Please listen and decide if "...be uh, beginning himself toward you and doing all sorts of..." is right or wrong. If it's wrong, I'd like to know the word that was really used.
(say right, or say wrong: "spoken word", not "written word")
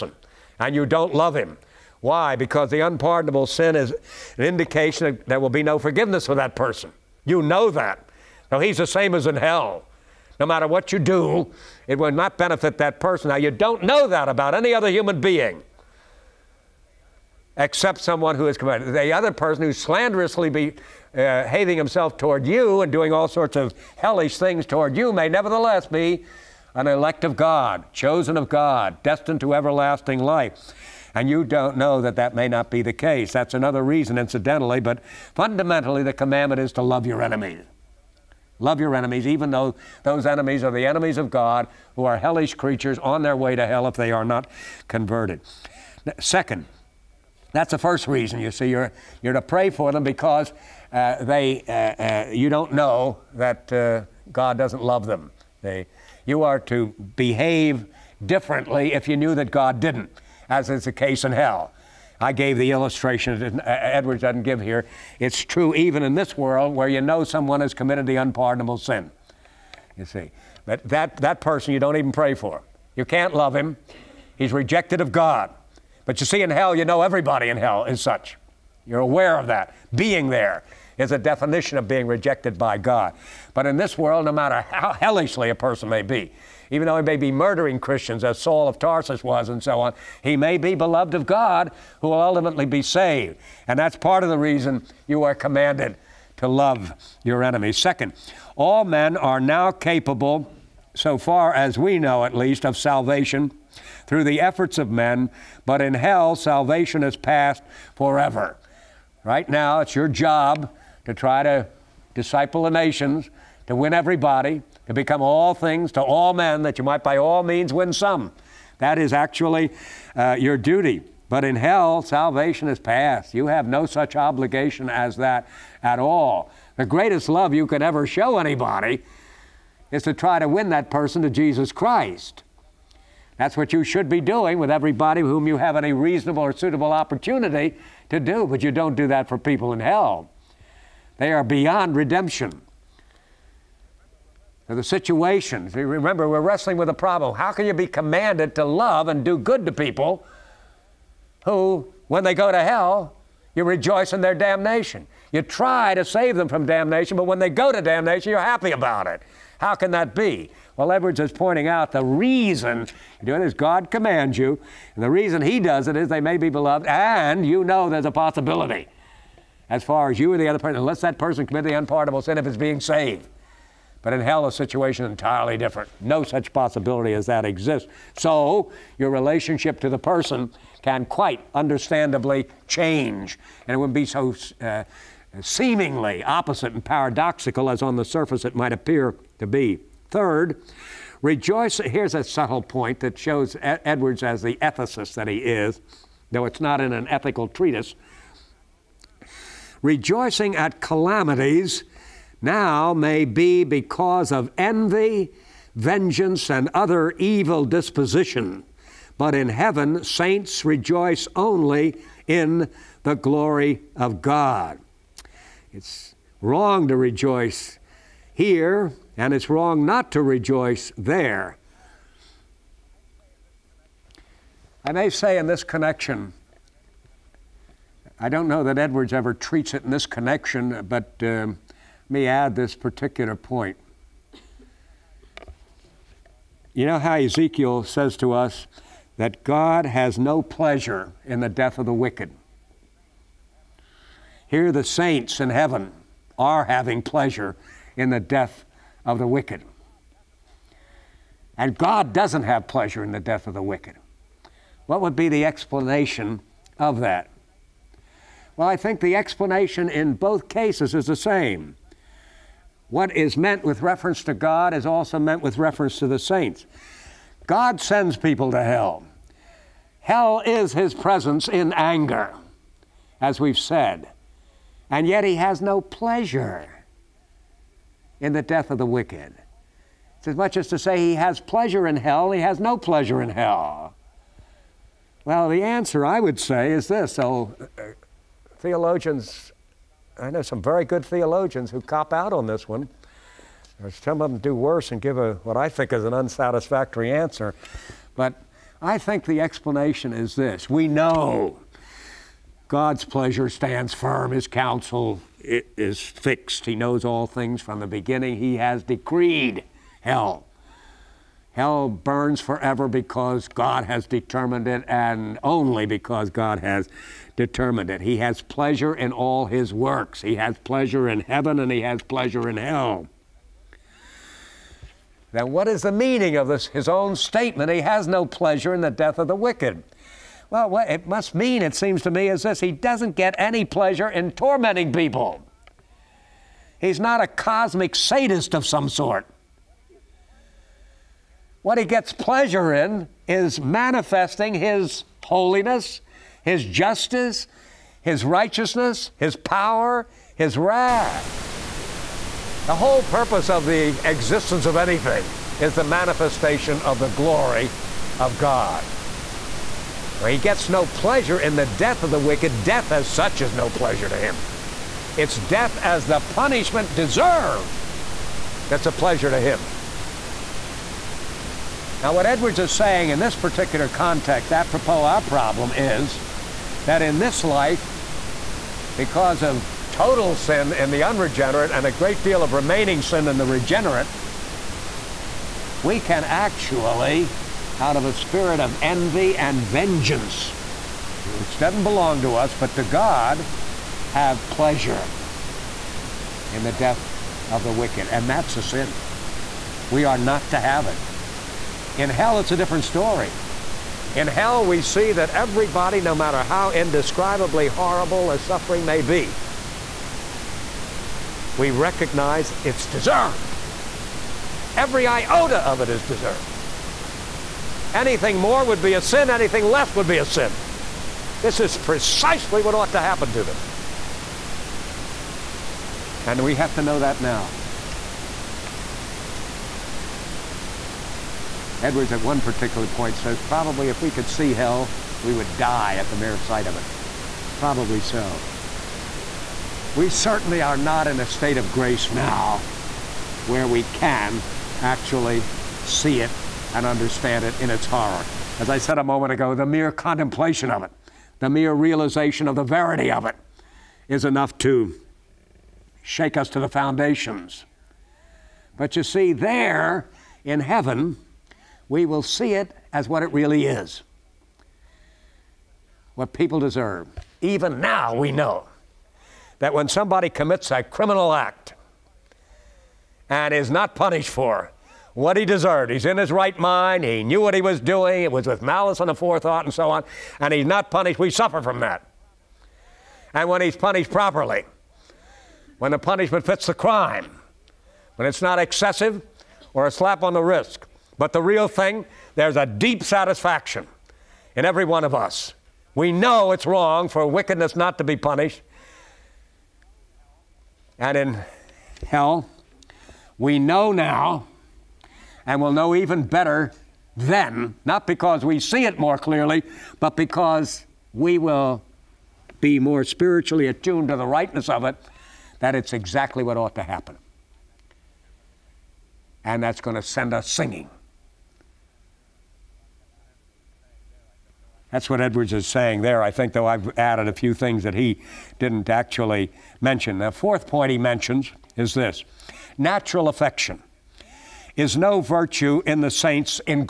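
wrong: "hating", not "beginning".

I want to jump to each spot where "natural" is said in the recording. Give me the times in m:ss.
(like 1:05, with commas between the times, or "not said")
8:52.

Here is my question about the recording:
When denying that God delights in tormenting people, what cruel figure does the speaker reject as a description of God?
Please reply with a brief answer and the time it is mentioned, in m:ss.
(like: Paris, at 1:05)
cosmic sadist, at 5:37.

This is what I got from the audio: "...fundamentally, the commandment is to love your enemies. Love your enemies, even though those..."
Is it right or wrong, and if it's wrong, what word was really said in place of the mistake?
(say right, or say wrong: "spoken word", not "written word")
right.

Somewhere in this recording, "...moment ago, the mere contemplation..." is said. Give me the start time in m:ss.
7:29.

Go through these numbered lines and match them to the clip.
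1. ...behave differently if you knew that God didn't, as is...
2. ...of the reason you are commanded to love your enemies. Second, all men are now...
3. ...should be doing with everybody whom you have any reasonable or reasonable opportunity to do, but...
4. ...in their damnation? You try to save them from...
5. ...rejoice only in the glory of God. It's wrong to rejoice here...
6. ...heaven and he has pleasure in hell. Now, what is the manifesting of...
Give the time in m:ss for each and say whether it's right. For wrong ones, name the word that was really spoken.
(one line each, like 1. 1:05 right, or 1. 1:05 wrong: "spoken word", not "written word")
1. 0:57 right
2. 1:34 right
3. 2:13 wrong: "suitable", not "reasonable"
4. 2:34 right
5. 3:30 right
6. 5:21 wrong: "meaning", not "manifesting".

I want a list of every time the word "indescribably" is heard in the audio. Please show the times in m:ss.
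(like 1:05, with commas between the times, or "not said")
6:46.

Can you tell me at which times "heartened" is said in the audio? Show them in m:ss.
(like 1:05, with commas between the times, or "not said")
not said.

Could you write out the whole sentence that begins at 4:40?
It's as much as to say he has pleasure in hell, he has no pleasure in hell.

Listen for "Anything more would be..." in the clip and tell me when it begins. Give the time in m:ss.
6:57.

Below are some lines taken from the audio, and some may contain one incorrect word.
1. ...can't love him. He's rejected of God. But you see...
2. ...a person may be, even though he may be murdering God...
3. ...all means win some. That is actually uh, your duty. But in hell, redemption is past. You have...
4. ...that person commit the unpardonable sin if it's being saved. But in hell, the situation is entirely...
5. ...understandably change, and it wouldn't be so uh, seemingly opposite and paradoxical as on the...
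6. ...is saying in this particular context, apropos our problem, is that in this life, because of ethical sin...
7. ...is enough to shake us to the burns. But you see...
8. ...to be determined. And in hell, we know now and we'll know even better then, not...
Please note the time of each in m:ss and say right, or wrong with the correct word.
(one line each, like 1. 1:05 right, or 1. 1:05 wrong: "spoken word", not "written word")
1. 1:13 right
2. 1:25 wrong: "Christians", not "God"
3. 1:57 wrong: "salvation", not "redemption"
4. 2:51 right
5. 3:01 right
6. 6:12 wrong: "total", not "ethical"
7. 7:34 wrong: "foundations", not "burns"
8. 8:17 wrong: "punished", not "determined".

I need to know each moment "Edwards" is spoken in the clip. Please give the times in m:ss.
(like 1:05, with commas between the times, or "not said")
1:03, 2:40, 3:13, 3:48, 6:12, 7:11, 8:45.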